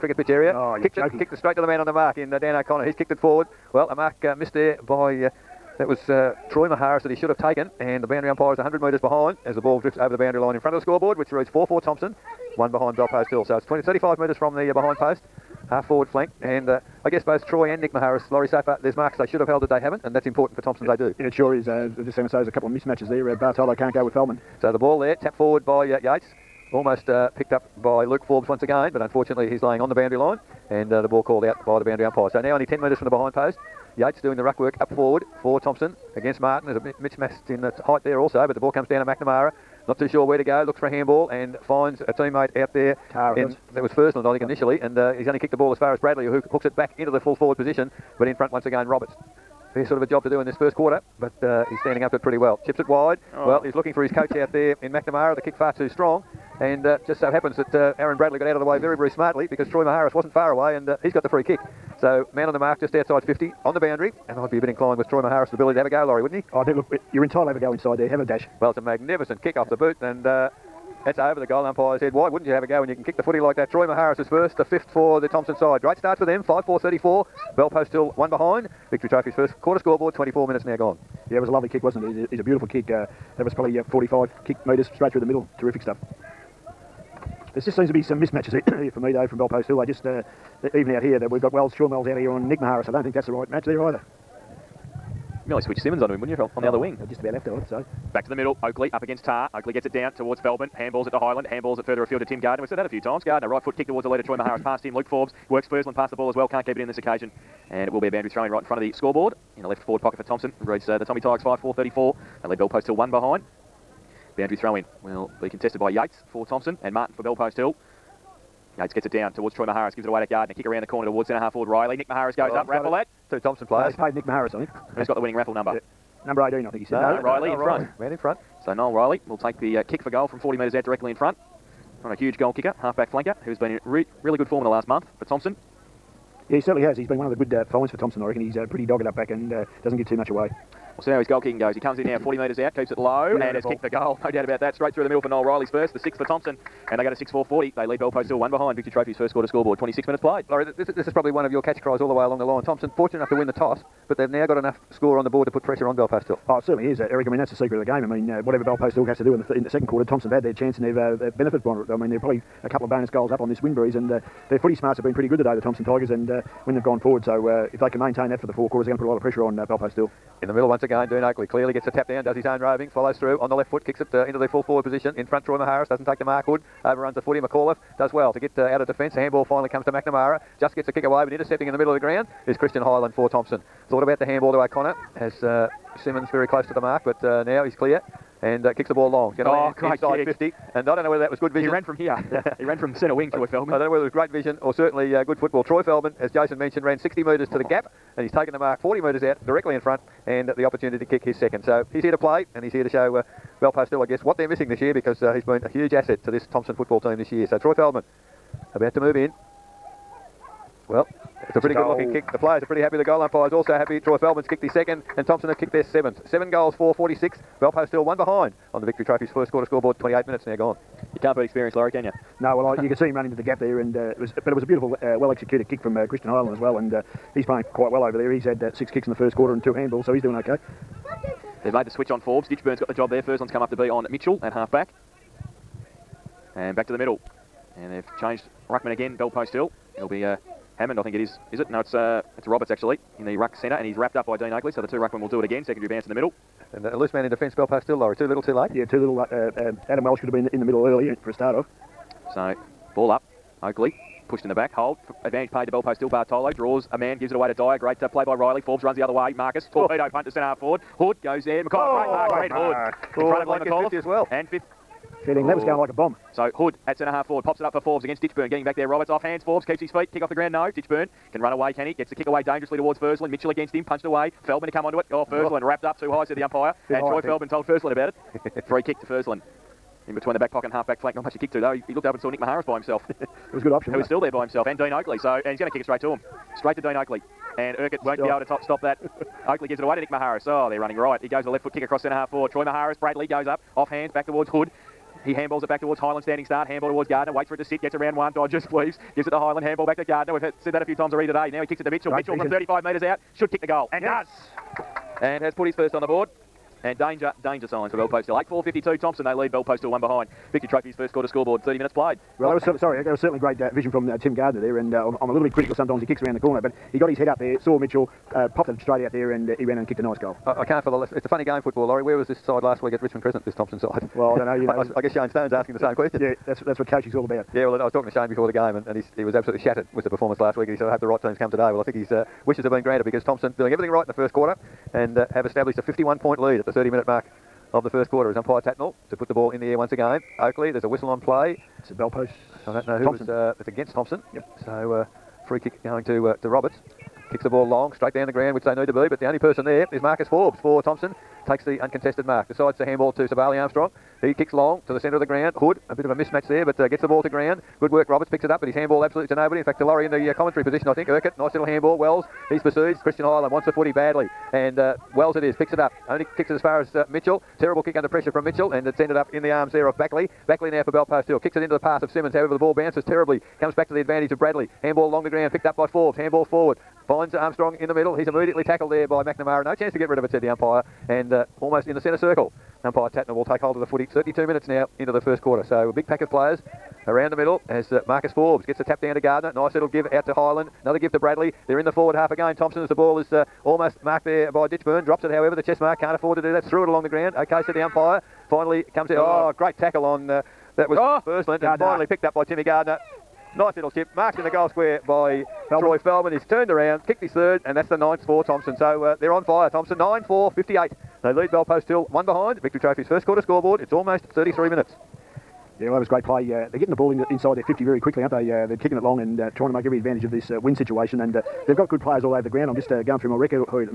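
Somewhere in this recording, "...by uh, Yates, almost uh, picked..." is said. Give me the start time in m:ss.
0:25.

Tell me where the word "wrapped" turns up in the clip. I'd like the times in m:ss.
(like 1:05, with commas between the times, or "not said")
4:03, 4:35.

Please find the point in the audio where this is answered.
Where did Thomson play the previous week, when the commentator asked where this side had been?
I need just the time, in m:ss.
5:23.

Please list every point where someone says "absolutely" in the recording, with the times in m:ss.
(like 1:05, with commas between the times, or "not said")
5:29, 5:59.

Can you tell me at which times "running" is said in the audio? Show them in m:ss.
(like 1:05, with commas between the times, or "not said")
4:50.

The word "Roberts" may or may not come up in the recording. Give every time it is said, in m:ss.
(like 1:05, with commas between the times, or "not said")
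0:48, 4:02, 4:28, 5:46, 5:58.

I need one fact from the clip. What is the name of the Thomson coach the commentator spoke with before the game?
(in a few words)
Shane Stone.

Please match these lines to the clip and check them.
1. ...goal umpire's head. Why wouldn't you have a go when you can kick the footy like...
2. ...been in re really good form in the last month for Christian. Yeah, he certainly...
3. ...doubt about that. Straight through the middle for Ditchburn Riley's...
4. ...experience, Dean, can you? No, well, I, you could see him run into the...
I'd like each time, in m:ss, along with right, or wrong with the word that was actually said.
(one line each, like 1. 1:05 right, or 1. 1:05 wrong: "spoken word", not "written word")
1. 1:11 right
2. 2:13 wrong: "Thomson", not "Christian"
3. 2:24 wrong: "Noel", not "Ditchburn"
4. 3:41 wrong: "Laurie", not "Dean".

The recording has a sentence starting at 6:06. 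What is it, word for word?
Only kicks it as far as uh, Mitchell.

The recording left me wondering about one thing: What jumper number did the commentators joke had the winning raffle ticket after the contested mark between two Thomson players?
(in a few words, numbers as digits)
18.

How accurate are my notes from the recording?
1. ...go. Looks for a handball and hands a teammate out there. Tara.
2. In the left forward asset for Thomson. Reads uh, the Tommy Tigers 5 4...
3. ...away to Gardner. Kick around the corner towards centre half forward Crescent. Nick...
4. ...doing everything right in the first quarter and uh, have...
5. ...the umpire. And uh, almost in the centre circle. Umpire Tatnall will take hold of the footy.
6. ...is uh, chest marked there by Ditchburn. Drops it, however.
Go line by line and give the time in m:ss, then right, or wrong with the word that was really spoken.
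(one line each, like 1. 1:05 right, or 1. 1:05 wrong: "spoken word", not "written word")
1. 0:40 wrong: "finds", not "hands"
2. 1:49 wrong: "pocket", not "asset"
3. 2:00 wrong: "Riley", not "Crescent"
4. 5:33 right
5. 6:20 right
6. 6:33 wrong: "almost", not "chest".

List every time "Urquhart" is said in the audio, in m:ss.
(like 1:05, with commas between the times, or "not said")
4:47, 6:01.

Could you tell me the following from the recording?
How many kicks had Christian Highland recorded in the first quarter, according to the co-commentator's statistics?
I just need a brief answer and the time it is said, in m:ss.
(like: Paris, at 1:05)
6, at 3:48.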